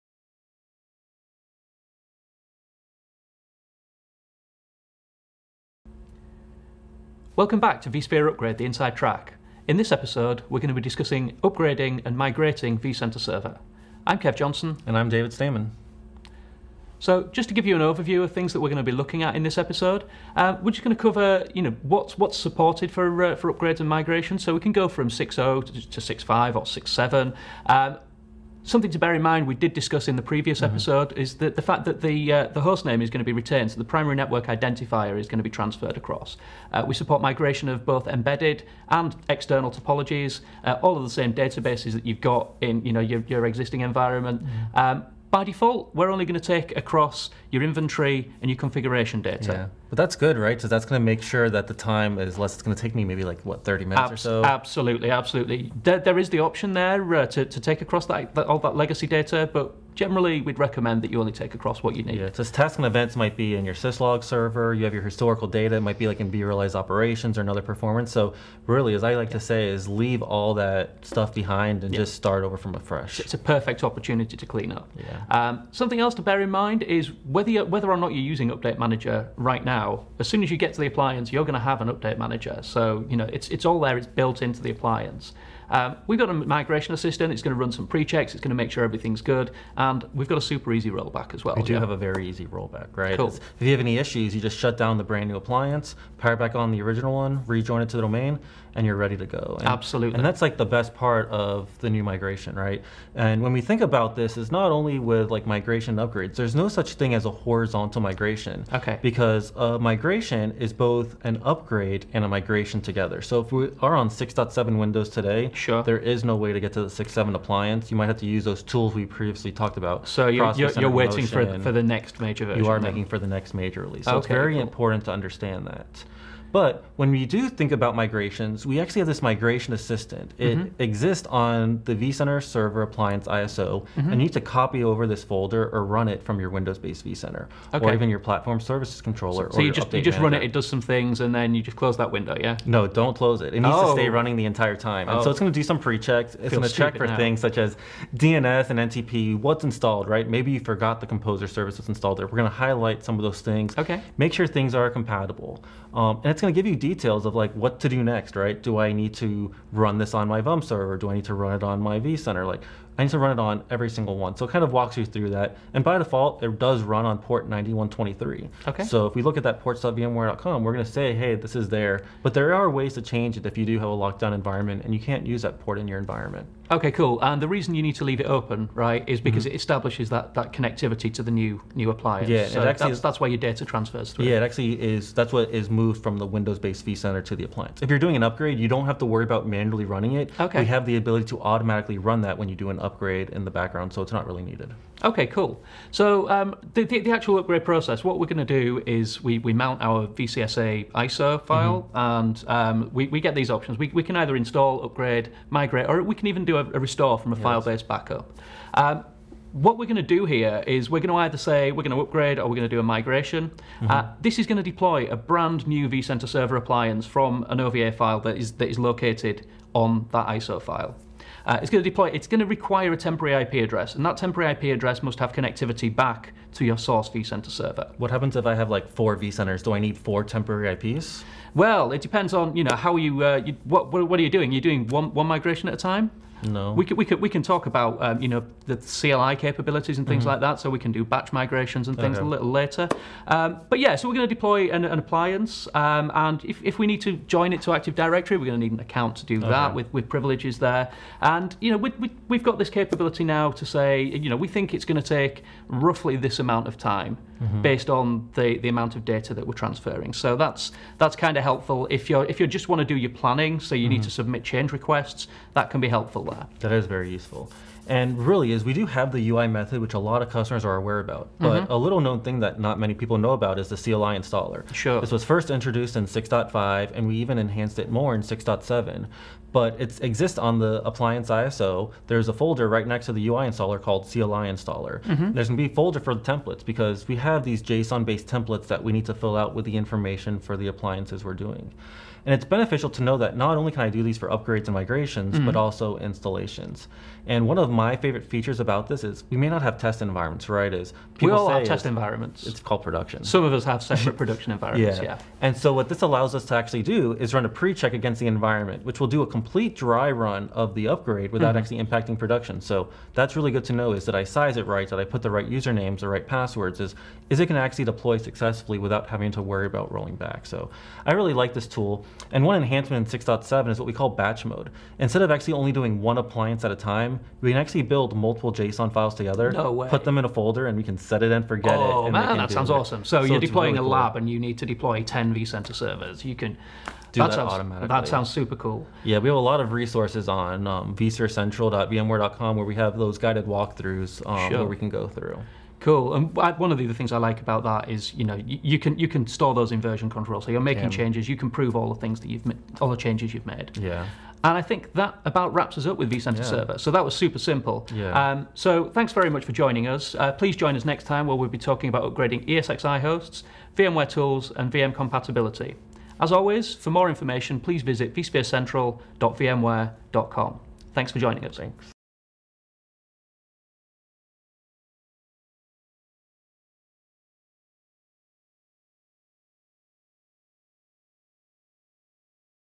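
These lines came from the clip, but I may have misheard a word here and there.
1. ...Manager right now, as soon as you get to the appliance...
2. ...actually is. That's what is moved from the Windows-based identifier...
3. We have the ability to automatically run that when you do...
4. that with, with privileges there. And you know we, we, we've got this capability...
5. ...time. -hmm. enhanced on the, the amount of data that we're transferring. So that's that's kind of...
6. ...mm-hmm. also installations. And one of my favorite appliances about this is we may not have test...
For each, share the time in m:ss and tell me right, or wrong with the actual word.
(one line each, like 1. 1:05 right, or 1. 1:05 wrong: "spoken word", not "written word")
1. 1:18 right
2. 3:04 wrong: "vCenter", not "identifier"
3. 3:10 right
4. 4:09 right
5. 4:16 wrong: "based", not "enhanced"
6. 4:55 wrong: "features", not "appliances".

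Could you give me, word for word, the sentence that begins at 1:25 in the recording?
Um, we've got a migration assistant.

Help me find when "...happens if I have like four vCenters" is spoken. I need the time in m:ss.
3:48.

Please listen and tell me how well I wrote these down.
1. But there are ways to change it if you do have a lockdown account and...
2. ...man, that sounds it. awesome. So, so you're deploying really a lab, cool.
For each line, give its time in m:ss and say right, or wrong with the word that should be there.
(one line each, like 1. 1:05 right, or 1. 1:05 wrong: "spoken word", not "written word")
1. 2:52 wrong: "environment", not "account"
2. 5:32 right.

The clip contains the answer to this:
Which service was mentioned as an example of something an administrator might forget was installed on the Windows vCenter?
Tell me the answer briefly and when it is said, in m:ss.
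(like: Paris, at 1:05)
composer service, at 2:31.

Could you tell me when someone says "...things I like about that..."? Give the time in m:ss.
5:46.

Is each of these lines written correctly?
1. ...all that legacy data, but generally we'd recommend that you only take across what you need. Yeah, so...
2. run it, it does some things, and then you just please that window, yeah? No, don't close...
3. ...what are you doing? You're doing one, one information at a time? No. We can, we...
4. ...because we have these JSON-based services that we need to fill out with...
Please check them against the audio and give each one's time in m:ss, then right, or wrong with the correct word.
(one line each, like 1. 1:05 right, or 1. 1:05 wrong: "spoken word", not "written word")
1. 0:58 right
2. 2:20 wrong: "close", not "please"
3. 3:53 wrong: "migration", not "information"
4. 4:46 wrong: "templates", not "services".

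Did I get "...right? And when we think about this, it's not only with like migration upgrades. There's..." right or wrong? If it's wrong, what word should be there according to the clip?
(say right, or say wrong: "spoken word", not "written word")
right.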